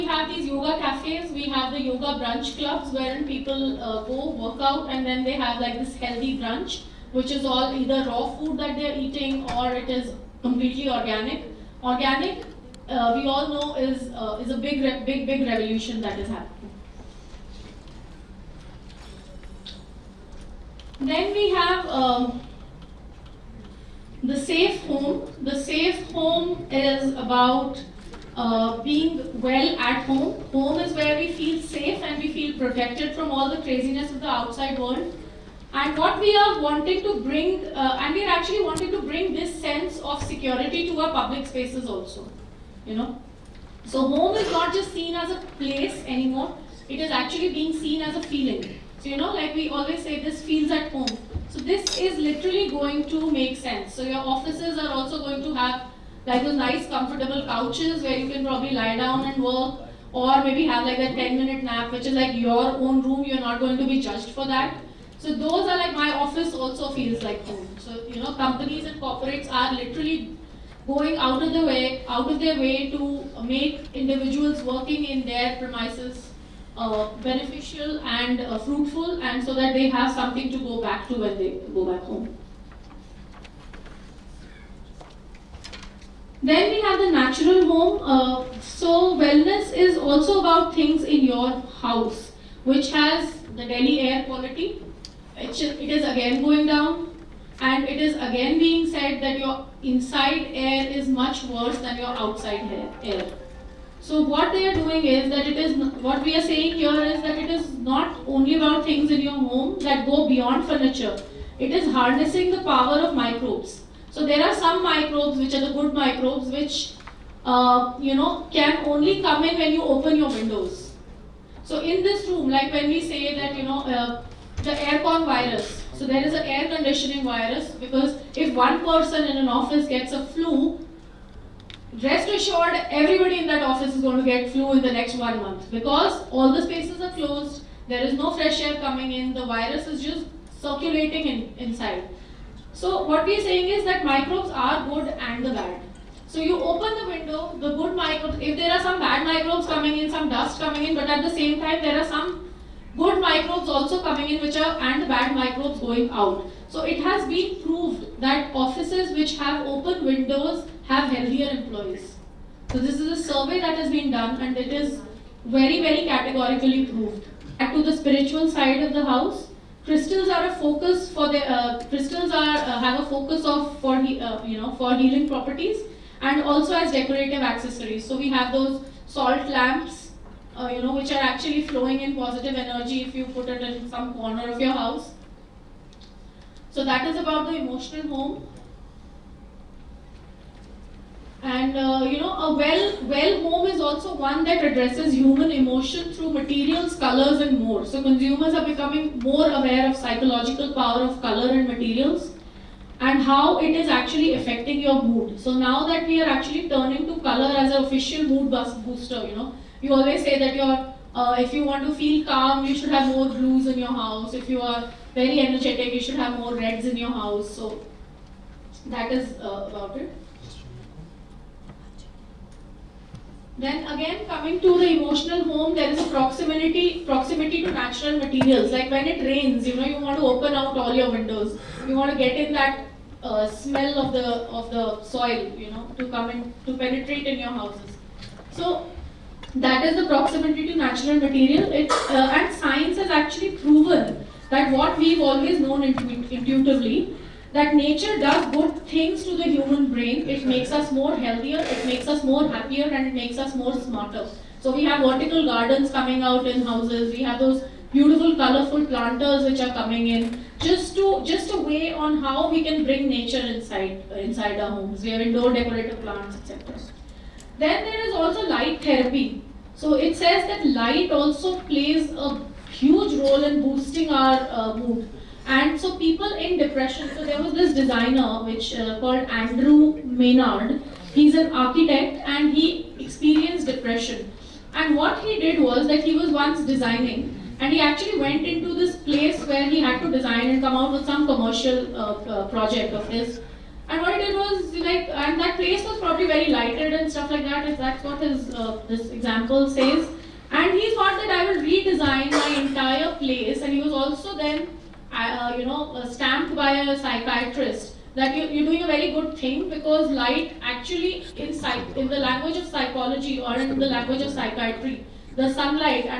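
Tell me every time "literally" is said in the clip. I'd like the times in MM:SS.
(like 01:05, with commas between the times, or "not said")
00:52, 01:09.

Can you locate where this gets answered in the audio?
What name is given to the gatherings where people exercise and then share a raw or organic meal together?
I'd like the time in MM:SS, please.
00:01.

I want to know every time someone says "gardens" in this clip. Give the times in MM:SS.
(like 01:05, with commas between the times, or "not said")
04:15.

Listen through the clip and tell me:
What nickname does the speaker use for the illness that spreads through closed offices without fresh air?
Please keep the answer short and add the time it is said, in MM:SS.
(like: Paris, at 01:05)
aircon virus, at 02:04.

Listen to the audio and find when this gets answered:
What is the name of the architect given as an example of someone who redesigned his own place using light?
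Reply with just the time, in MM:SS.
04:39.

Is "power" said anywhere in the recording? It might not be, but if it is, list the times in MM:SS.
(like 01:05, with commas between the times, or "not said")
01:52, 03:20.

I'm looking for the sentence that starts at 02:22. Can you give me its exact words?
So what we are saying is that microbes are good and the bad.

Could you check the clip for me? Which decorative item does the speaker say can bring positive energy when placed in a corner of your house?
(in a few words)
salt lamps.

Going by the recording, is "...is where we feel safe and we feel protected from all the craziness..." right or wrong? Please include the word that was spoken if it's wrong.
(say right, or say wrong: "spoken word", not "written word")
right.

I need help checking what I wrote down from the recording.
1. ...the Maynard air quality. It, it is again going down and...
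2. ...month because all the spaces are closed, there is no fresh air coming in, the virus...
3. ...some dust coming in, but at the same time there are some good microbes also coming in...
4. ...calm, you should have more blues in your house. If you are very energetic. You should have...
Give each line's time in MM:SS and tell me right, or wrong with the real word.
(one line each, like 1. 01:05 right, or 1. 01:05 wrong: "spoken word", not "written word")
1. 01:33 wrong: "Delhi", not "Maynard"
2. 02:15 right
3. 02:30 right
4. 03:32 right.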